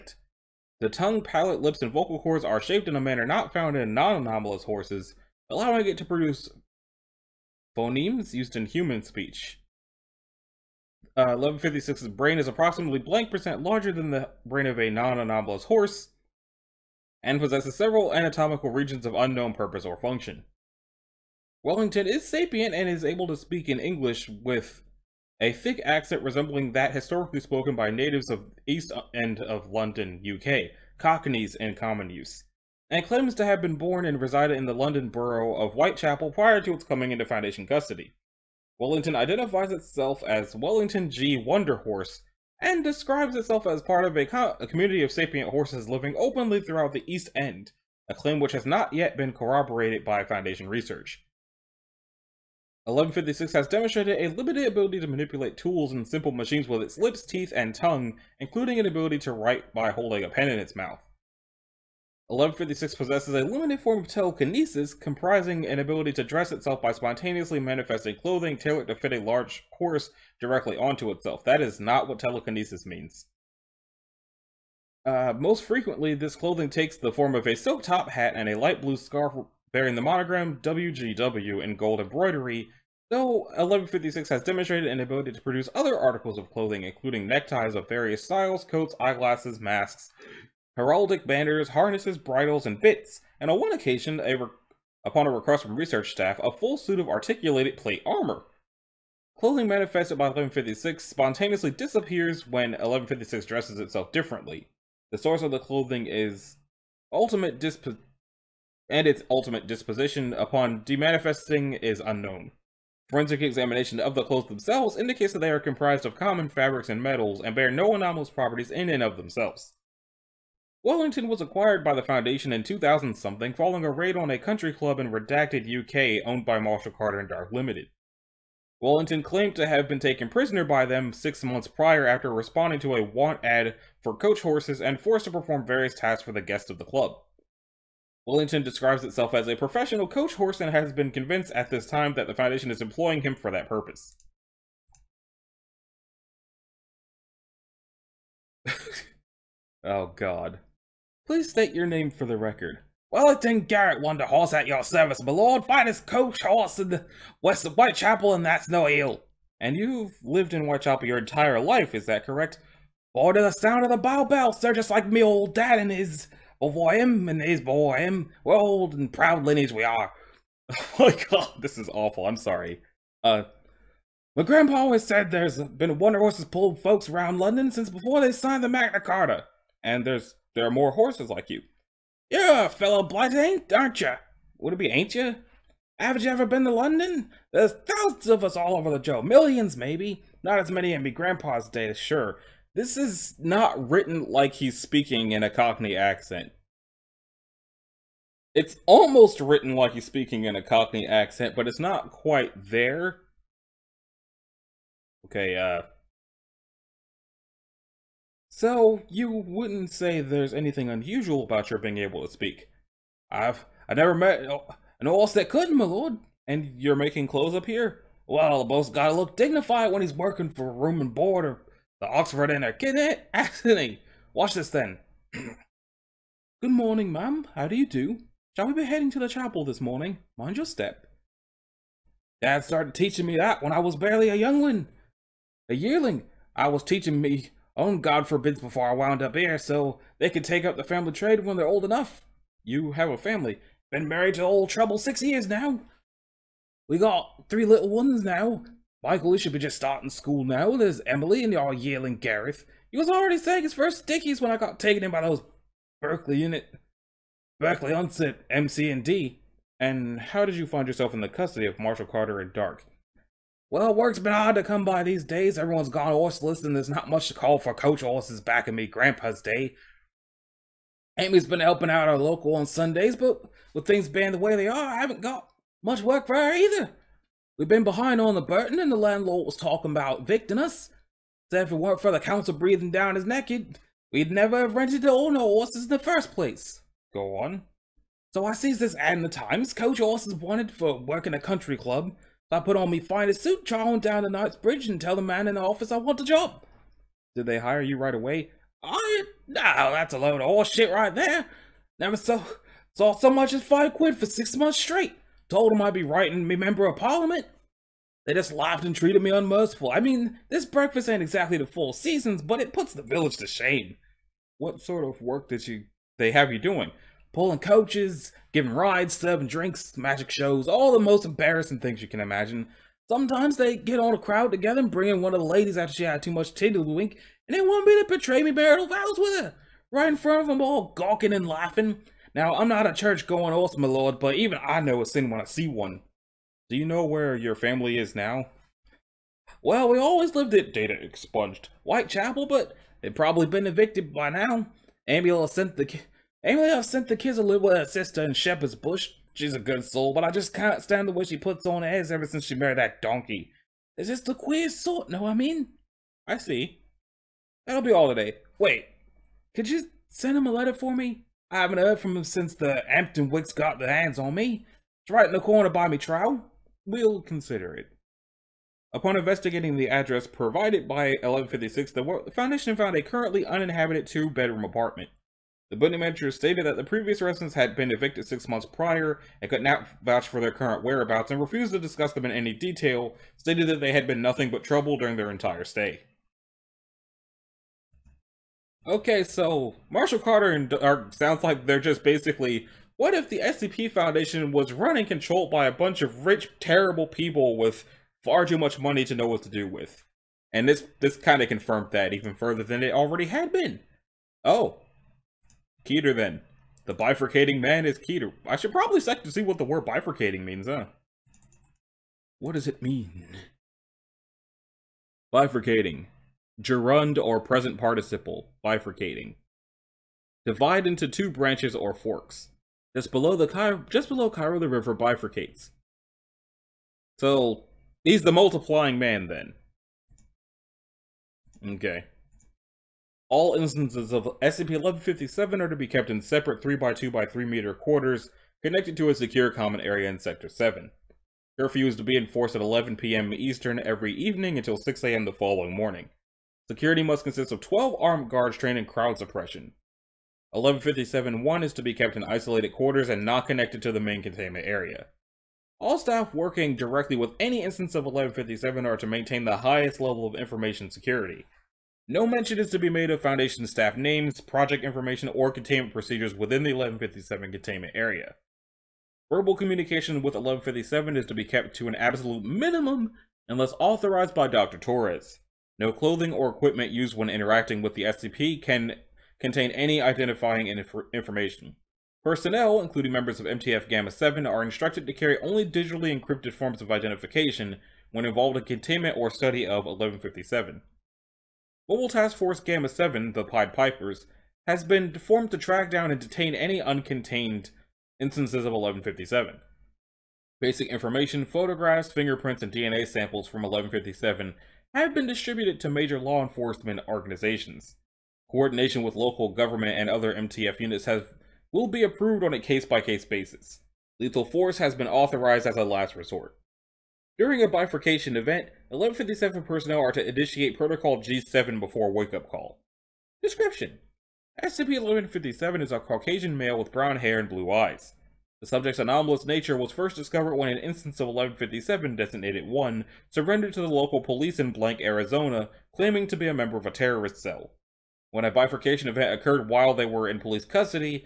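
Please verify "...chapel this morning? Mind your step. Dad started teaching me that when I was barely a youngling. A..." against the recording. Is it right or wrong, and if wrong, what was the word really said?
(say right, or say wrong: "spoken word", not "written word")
right.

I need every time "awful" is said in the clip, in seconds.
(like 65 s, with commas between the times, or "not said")
171 s.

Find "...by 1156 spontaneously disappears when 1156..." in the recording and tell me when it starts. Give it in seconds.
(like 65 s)
100 s.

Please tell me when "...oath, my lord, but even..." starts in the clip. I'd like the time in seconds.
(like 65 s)
333 s.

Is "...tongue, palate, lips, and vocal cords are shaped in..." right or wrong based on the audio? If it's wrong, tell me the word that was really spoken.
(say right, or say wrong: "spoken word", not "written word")
right.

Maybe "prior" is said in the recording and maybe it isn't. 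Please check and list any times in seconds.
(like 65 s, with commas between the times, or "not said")
36 s, 131 s, 378 s.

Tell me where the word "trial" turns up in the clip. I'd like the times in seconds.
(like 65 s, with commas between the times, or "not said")
365 s.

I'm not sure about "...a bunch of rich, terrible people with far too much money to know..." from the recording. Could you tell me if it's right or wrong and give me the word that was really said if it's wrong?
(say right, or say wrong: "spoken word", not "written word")
right.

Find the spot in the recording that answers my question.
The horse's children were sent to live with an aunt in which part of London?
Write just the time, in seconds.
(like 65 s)
348 s.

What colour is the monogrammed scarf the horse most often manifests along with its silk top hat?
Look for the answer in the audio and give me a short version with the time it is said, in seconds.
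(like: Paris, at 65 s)
light blue, at 78 s.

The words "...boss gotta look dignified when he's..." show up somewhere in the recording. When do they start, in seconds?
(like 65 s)
218 s.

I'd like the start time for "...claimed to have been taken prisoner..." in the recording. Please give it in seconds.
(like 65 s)
129 s.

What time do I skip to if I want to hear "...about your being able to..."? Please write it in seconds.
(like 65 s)
211 s.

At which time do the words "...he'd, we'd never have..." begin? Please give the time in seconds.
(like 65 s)
283 s.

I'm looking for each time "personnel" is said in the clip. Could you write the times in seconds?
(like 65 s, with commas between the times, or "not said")
482 s, 519 s.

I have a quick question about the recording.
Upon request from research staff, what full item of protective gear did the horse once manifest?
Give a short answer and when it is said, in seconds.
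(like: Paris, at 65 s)
articulated plate armor, at 97 s.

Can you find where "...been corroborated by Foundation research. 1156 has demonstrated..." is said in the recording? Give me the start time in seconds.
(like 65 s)
49 s.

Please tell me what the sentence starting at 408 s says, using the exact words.
I should probably check to see what the word bifurcating means, huh?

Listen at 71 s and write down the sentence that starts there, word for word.
That is not what telekinesis means.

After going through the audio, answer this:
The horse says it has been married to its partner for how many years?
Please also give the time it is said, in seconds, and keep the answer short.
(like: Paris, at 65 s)
6, at 244 s.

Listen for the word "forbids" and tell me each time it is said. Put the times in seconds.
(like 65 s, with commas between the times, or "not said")
238 s.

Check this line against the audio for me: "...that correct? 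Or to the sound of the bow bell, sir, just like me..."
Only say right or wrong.
right.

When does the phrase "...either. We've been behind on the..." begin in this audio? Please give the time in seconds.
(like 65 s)
276 s.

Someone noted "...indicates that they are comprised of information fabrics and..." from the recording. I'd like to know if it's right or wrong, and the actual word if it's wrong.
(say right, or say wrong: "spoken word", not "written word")
wrong: "common", not "information".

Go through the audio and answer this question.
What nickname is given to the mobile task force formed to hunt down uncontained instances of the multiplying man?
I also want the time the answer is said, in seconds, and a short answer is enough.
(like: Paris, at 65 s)
The Pied Pipers, at 493 s.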